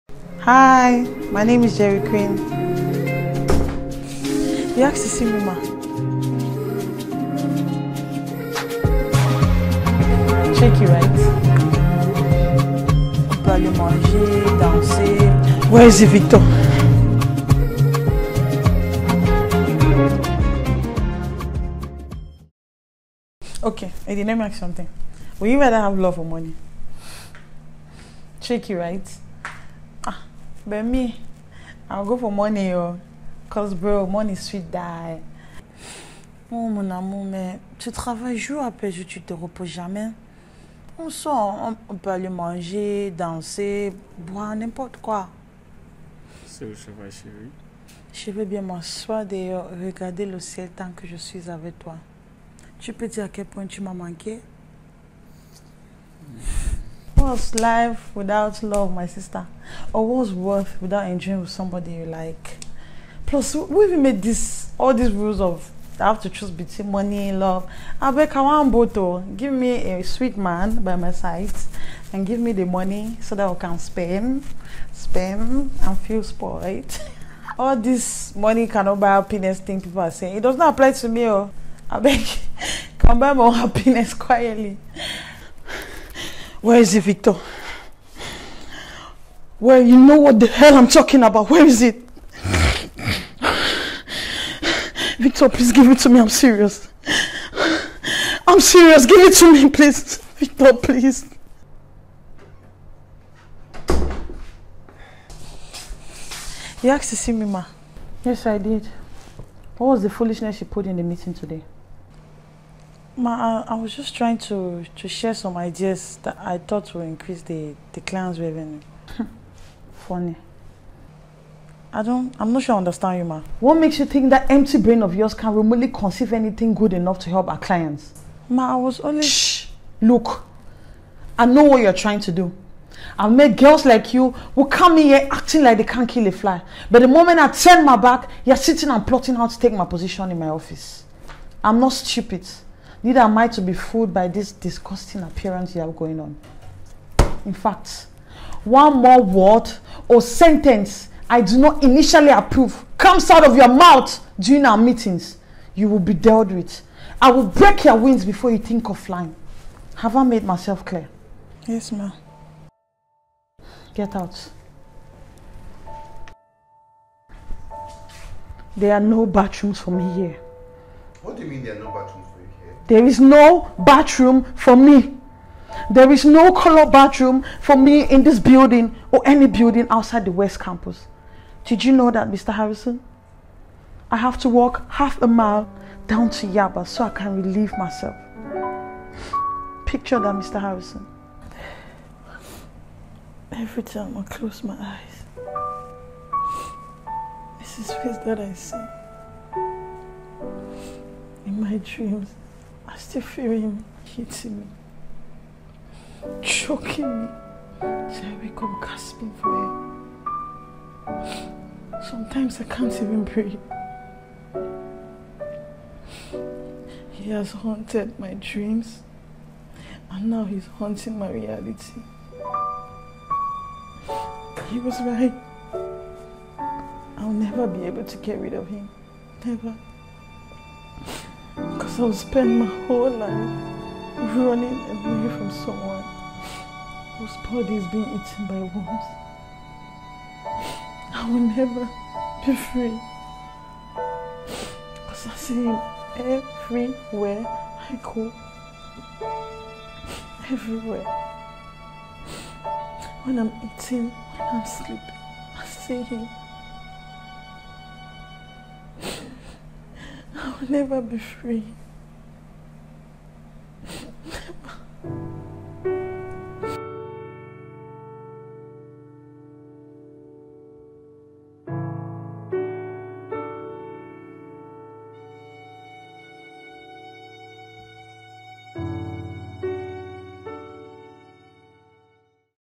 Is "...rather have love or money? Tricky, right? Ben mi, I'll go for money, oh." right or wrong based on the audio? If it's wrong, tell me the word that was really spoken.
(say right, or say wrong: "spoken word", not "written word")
right.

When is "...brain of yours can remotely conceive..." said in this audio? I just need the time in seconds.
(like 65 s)
124 s.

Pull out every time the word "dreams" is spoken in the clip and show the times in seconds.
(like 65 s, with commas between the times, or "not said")
201 s, 218 s.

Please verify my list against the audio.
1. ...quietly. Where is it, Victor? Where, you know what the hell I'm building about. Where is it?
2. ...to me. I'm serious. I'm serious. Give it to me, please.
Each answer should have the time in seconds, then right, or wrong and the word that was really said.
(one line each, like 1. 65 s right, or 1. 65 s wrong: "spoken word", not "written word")
1. 84 s wrong: "talking", not "building"
2. 95 s right.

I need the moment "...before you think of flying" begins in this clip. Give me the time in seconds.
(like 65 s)
158 s.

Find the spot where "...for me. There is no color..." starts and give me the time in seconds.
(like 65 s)
174 s.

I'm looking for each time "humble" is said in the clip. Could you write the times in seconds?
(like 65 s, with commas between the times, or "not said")
not said.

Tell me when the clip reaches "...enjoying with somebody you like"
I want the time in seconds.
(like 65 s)
61 s.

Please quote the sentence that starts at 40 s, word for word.
On sort, on, peut aller manger, danser, boire, n'importe quoi.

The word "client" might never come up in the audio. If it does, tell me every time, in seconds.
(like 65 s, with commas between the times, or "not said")
118 s, 127 s.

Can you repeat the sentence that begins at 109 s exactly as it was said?
What was the foolishness she put in the meeting today?